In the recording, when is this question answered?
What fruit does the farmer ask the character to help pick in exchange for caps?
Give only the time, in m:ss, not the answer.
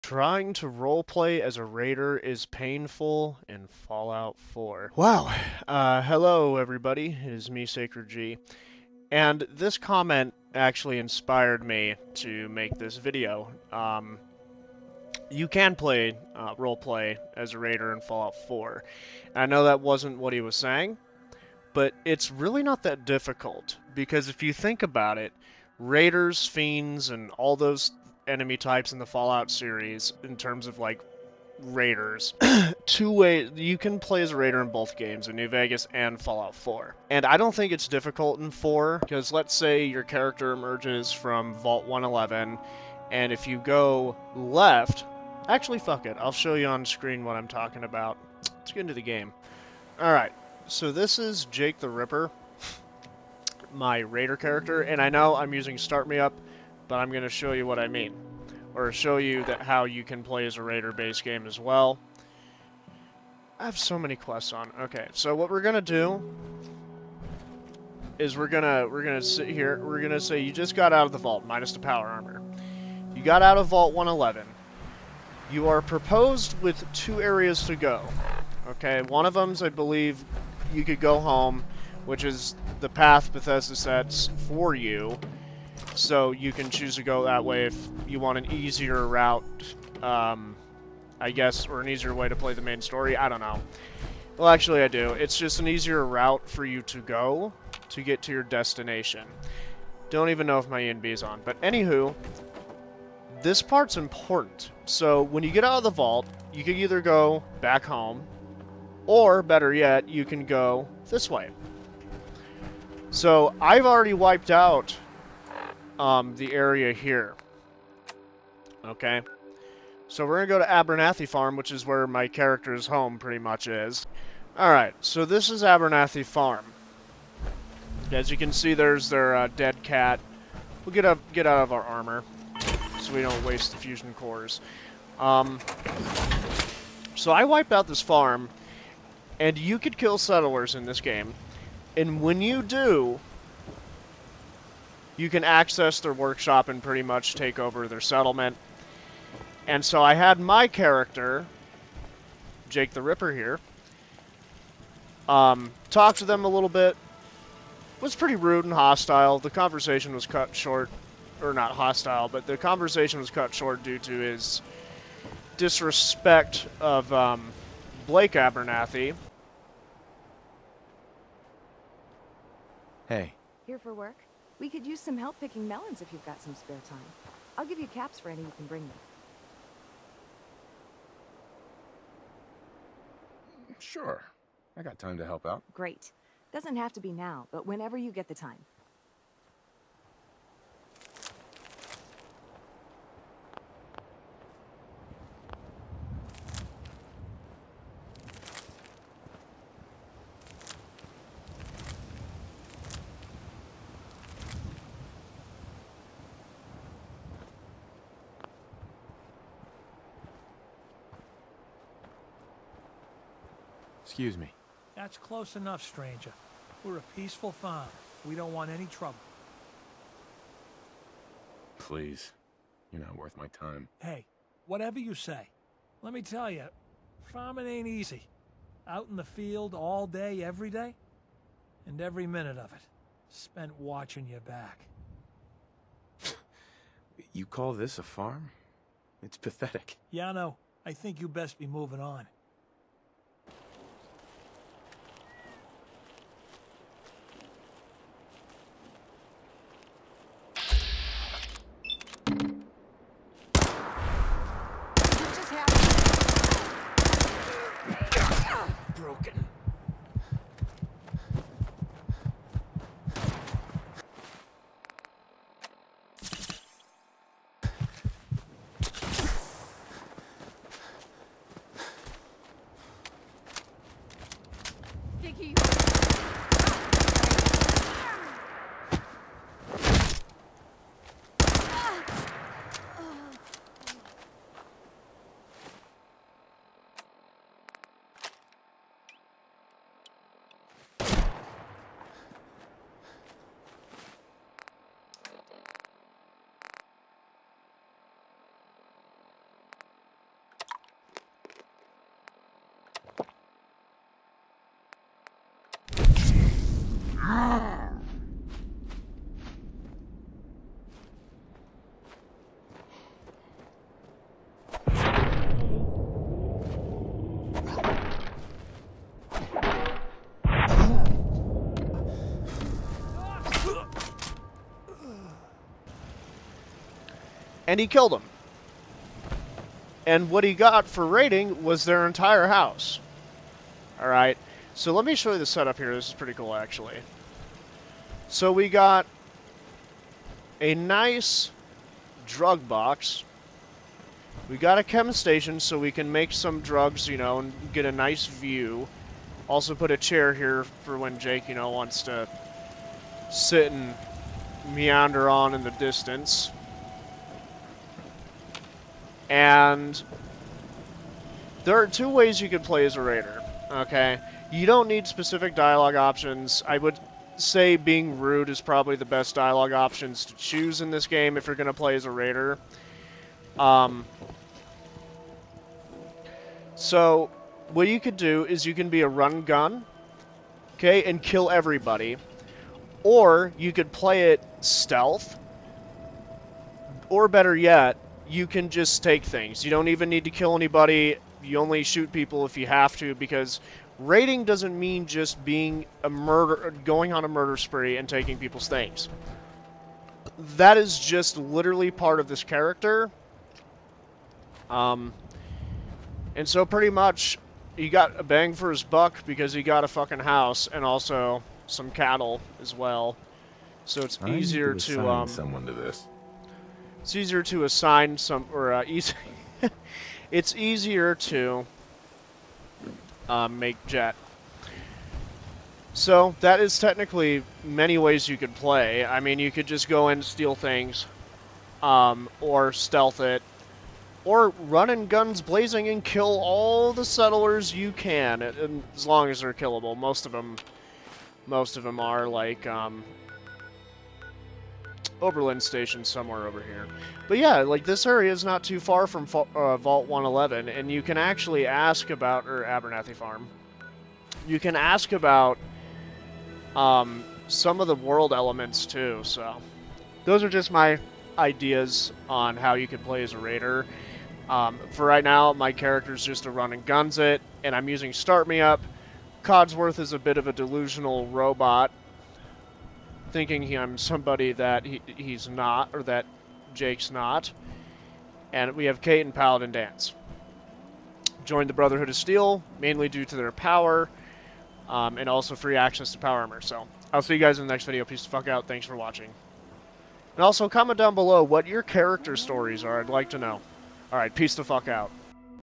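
2:55.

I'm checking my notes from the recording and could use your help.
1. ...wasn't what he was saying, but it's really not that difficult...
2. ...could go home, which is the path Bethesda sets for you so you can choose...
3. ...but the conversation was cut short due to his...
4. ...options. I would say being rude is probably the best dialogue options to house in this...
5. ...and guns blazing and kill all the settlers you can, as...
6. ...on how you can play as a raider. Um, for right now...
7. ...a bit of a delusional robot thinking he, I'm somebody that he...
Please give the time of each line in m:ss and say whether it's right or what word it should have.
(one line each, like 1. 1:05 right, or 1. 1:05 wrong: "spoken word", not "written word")
1. 0:19 right
2. 1:20 right
3. 2:42 right
4. 6:05 wrong: "choose", not "house"
5. 7:14 right
6. 7:42 right
7. 7:50 right.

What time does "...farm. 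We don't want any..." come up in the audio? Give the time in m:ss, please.
3:37.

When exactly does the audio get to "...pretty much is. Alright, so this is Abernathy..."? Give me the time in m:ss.
2:03.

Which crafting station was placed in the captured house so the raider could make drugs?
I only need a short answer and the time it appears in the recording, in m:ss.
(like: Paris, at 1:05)
Chem station, at 5:44.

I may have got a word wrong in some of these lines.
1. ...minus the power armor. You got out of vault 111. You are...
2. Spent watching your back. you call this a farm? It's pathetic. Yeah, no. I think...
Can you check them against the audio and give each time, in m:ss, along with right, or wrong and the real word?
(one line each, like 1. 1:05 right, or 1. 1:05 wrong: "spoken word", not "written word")
1. 1:11 right
2. 3:53 right.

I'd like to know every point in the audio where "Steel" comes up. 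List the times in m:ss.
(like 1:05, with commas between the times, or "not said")
8:02.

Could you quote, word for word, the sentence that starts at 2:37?
It was pretty rude and hostile.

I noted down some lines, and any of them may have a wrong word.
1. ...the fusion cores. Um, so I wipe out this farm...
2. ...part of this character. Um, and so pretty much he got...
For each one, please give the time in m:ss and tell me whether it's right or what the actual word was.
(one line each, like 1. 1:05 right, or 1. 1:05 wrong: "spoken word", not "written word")
1. 2:13 right
2. 6:41 right.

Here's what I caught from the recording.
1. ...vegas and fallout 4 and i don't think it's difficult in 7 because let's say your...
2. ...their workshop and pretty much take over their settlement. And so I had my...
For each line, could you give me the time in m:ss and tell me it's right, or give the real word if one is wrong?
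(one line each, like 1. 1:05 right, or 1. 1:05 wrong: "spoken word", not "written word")
1. 0:35 wrong: "4", not "7"
2. 2:25 right.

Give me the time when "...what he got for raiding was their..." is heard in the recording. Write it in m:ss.
5:30.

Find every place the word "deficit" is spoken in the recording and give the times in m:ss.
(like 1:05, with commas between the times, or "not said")
not said.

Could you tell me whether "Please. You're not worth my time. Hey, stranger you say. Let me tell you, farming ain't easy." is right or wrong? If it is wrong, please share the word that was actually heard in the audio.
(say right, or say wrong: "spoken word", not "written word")
wrong: "whatever", not "stranger".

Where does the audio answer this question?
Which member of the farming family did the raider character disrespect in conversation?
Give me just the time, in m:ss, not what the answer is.
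2:48.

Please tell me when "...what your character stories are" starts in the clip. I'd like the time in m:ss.
8:11.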